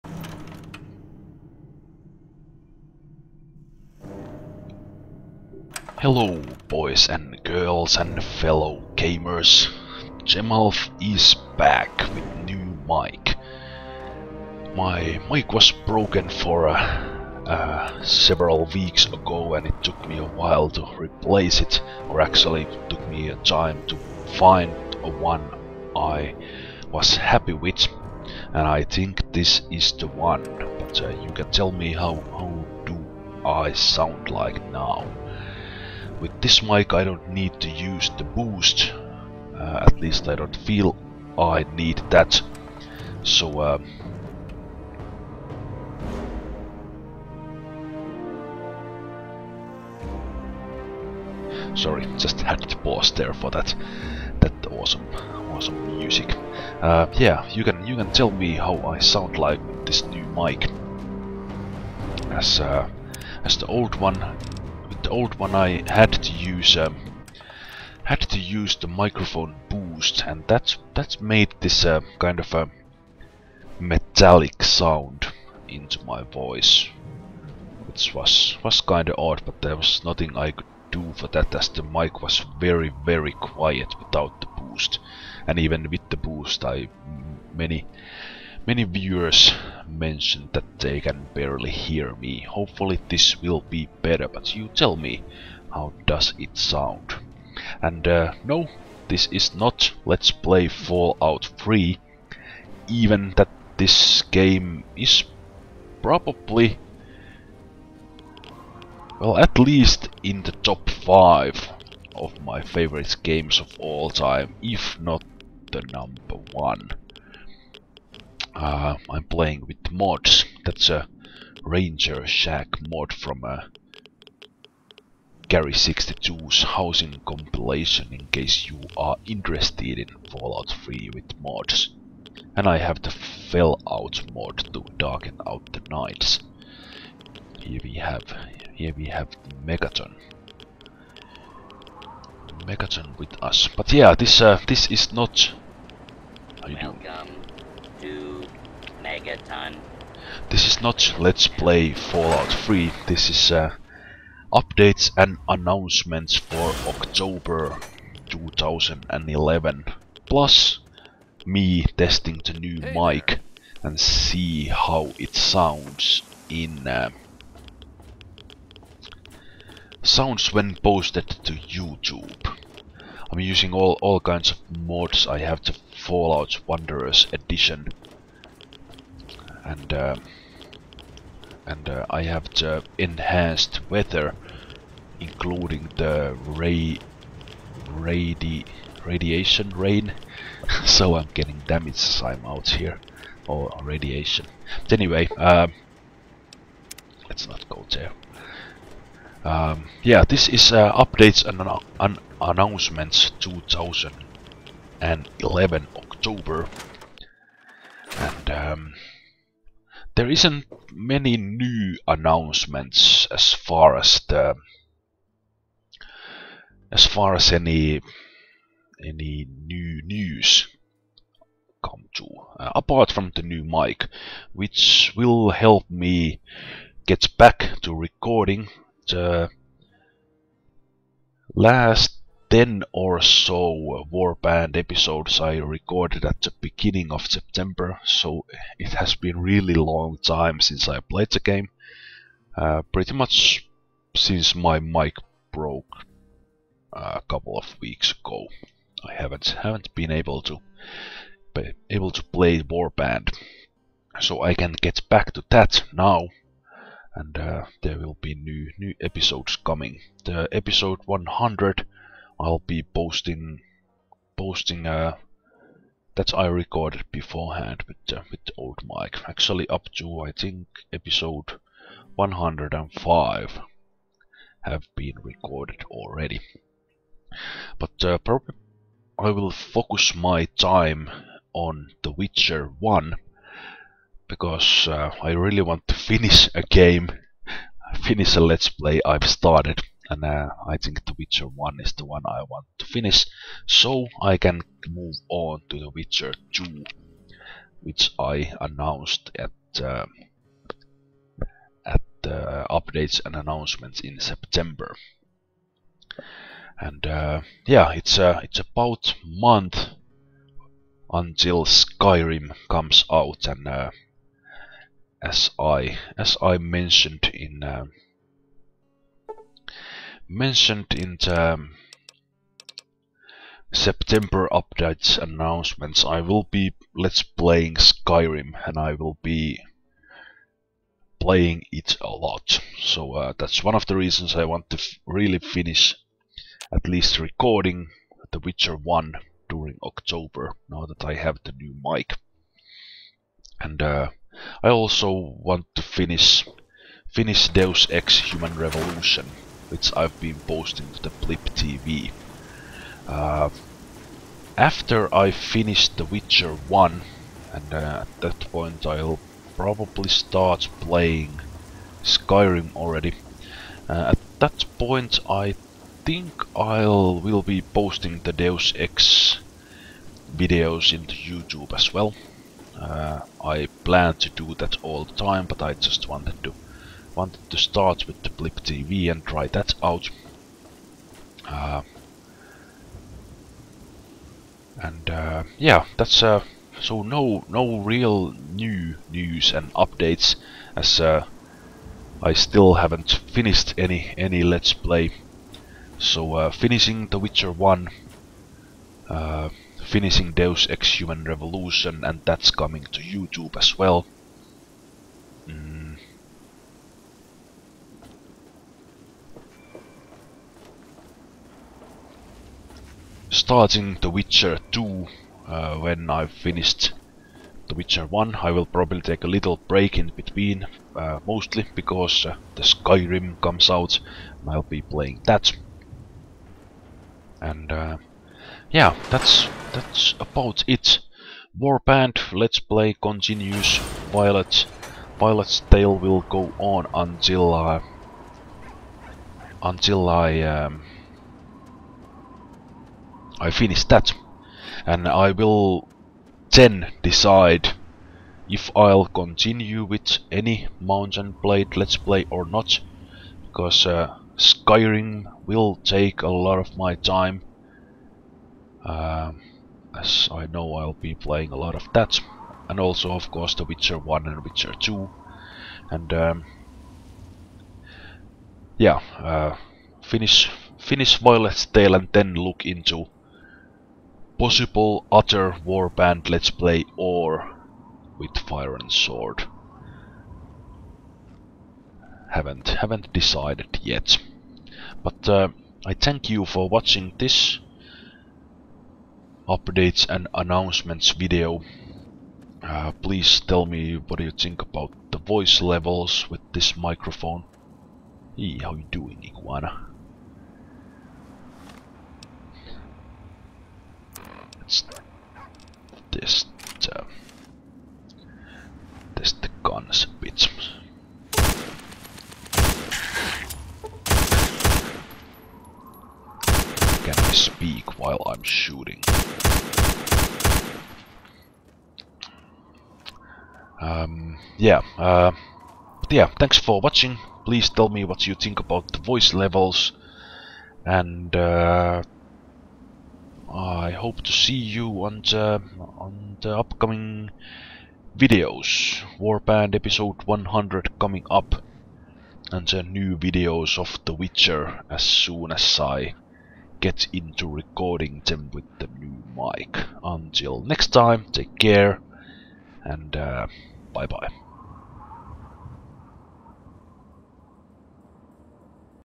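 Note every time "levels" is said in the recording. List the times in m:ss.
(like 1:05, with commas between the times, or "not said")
8:15, 8:49.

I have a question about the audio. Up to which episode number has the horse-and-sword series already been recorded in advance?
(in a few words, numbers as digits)
105.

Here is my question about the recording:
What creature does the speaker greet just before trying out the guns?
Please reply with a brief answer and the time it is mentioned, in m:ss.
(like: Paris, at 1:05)
Iguana, at 8:19.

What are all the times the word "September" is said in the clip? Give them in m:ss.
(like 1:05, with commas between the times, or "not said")
3:57, 5:04, 5:23.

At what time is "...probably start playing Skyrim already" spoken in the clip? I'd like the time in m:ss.
5:59.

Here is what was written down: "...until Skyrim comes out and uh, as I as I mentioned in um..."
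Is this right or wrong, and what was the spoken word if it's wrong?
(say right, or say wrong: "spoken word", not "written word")
right.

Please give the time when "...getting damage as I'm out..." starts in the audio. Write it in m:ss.
3:11.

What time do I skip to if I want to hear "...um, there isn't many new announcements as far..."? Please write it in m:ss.
3:28.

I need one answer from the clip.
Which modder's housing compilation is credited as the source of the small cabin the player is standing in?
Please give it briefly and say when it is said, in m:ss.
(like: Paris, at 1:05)
Gary 62, at 2:05.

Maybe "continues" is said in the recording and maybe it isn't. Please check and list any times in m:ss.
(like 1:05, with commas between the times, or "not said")
7:13, 7:29.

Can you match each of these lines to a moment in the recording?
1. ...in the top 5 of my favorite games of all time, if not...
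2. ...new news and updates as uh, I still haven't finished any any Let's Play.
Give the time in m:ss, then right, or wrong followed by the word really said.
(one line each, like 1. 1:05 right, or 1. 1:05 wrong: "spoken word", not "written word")
1. 1:50 right
2. 6:28 right.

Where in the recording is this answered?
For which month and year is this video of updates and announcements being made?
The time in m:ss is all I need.
2:36.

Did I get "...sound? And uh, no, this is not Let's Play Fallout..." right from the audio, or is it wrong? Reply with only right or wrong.
right.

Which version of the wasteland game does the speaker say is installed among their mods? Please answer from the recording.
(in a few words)
Fallout Wanderers edition.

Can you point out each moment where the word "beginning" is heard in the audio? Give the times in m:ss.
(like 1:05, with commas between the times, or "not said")
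3:56.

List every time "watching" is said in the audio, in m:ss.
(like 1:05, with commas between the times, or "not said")
8:06, 8:46.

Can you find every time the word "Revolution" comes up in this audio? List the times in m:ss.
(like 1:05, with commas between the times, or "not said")
5:48, 6:41.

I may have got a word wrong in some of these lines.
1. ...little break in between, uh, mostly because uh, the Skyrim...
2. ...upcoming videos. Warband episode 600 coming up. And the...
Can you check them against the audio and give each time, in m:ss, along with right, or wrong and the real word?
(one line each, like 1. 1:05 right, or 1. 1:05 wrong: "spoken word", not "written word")
1. 6:59 right
2. 8:56 wrong: "100", not "600".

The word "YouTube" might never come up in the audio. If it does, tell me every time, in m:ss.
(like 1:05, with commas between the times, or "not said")
2:51, 6:11, 6:43.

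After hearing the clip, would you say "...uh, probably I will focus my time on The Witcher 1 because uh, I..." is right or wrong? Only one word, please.
right.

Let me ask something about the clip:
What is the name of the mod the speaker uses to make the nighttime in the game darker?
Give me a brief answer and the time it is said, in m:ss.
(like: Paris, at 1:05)
Fellout, at 2:13.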